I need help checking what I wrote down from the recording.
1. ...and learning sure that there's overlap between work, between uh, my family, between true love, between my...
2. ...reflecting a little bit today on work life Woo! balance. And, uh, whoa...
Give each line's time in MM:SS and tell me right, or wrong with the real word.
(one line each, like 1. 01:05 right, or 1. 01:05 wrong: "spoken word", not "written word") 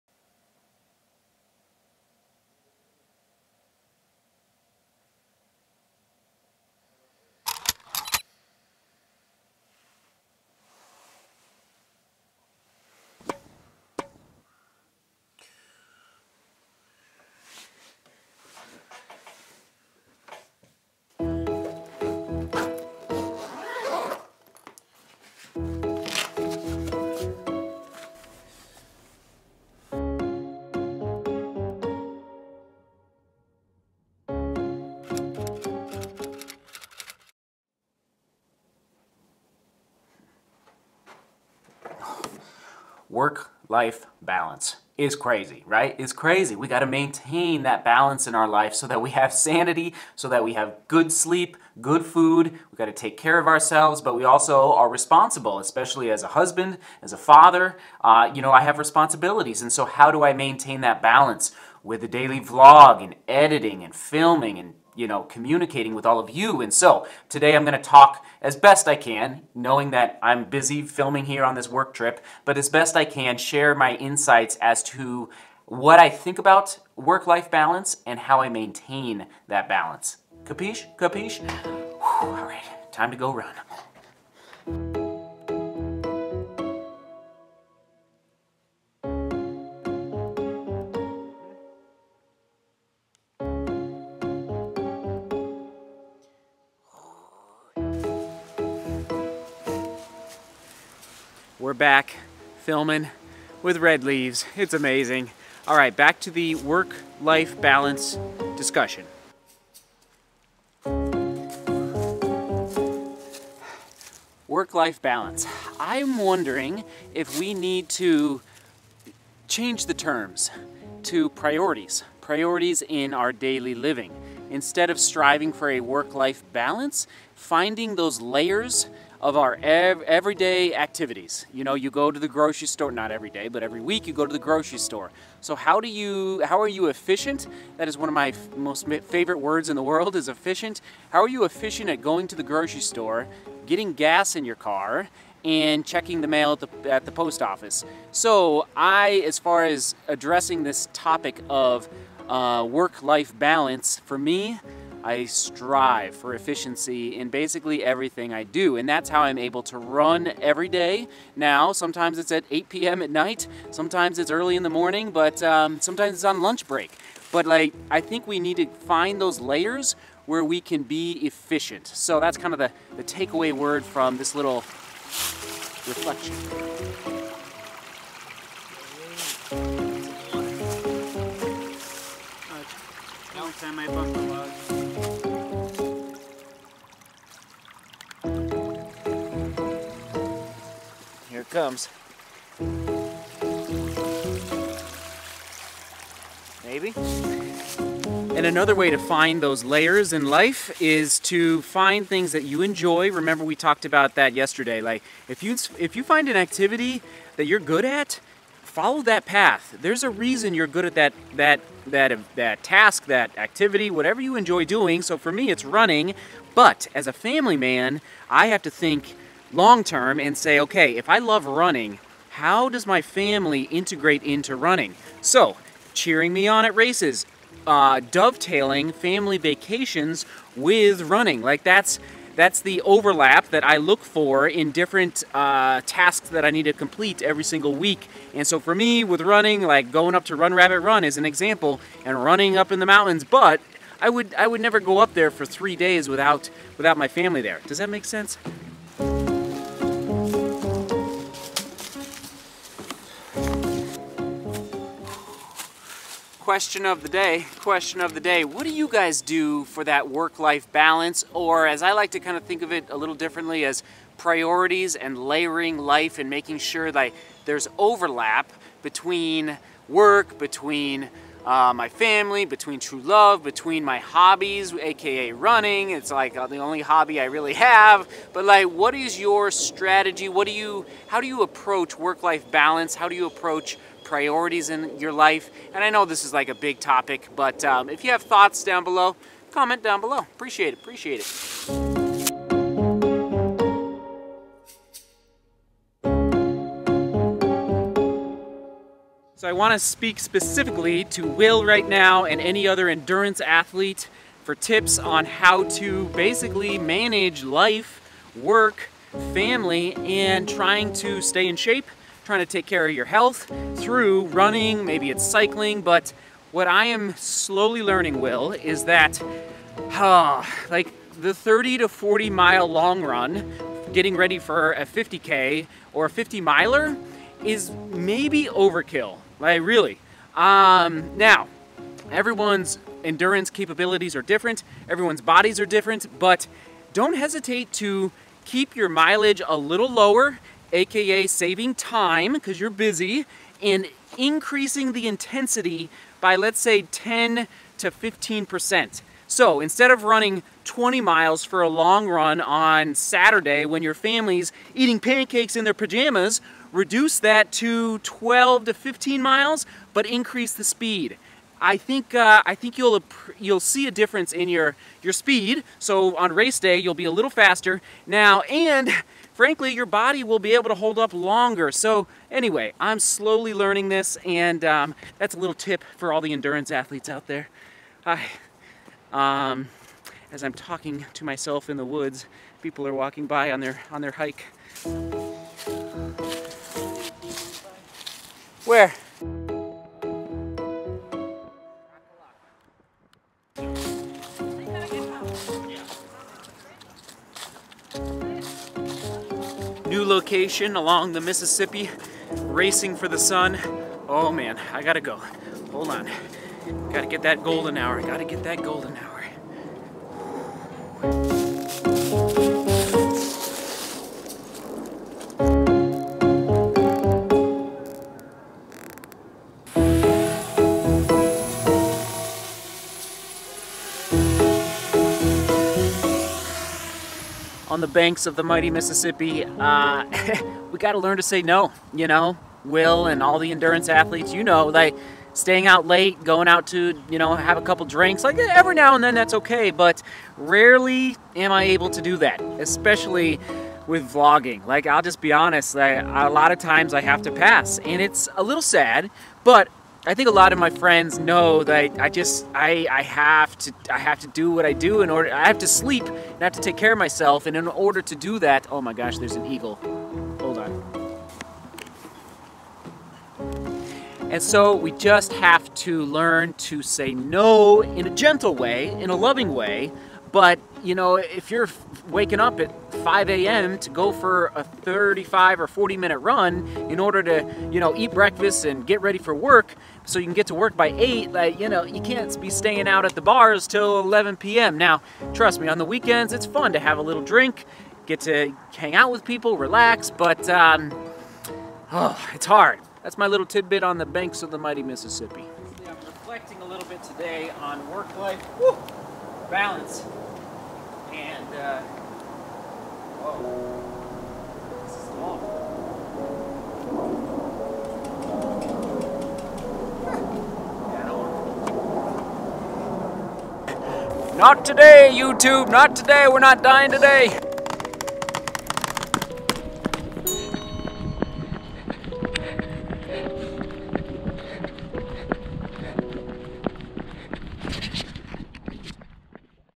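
1. 04:26 wrong: "making", not "learning"
2. 08:16 right.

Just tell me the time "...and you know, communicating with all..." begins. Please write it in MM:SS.
01:04.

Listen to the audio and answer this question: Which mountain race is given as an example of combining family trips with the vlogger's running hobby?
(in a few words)
Run Rabbit Run.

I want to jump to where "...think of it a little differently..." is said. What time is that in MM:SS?
04:22.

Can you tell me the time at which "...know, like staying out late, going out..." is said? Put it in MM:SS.
07:14.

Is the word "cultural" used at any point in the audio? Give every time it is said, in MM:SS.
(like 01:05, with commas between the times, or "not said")
not said.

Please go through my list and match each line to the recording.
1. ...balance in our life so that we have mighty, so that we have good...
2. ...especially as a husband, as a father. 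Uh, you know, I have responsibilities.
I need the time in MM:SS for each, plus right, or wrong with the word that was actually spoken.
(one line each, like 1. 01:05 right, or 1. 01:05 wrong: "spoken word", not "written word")
1. 00:47 wrong: "sanity", not "mighty"
2. 00:55 right.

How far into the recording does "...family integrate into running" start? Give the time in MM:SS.
03:43.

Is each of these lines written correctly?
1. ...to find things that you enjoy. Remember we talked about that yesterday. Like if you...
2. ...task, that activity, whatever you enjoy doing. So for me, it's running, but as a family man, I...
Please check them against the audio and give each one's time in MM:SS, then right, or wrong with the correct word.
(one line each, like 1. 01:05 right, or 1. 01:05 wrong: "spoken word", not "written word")
1. 03:21 right
2. 03:32 right.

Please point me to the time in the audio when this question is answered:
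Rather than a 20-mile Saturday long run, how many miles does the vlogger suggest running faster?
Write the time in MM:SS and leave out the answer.
05:57.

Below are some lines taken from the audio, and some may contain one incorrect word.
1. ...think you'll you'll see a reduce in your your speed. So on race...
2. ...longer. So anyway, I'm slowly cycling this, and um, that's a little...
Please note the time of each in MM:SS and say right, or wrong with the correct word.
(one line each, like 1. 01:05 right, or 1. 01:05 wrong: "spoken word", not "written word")
1. 06:02 wrong: "difference", not "reduce"
2. 06:11 wrong: "learning", not "cycling".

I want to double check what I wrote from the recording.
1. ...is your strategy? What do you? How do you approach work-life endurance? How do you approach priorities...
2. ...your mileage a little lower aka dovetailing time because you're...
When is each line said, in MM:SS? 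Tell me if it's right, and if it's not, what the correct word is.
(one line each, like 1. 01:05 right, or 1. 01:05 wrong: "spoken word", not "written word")
1. 04:38 wrong: "balance", not "endurance"
2. 05:38 wrong: "saving", not "dovetailing".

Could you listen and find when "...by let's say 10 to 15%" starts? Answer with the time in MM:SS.
05:46.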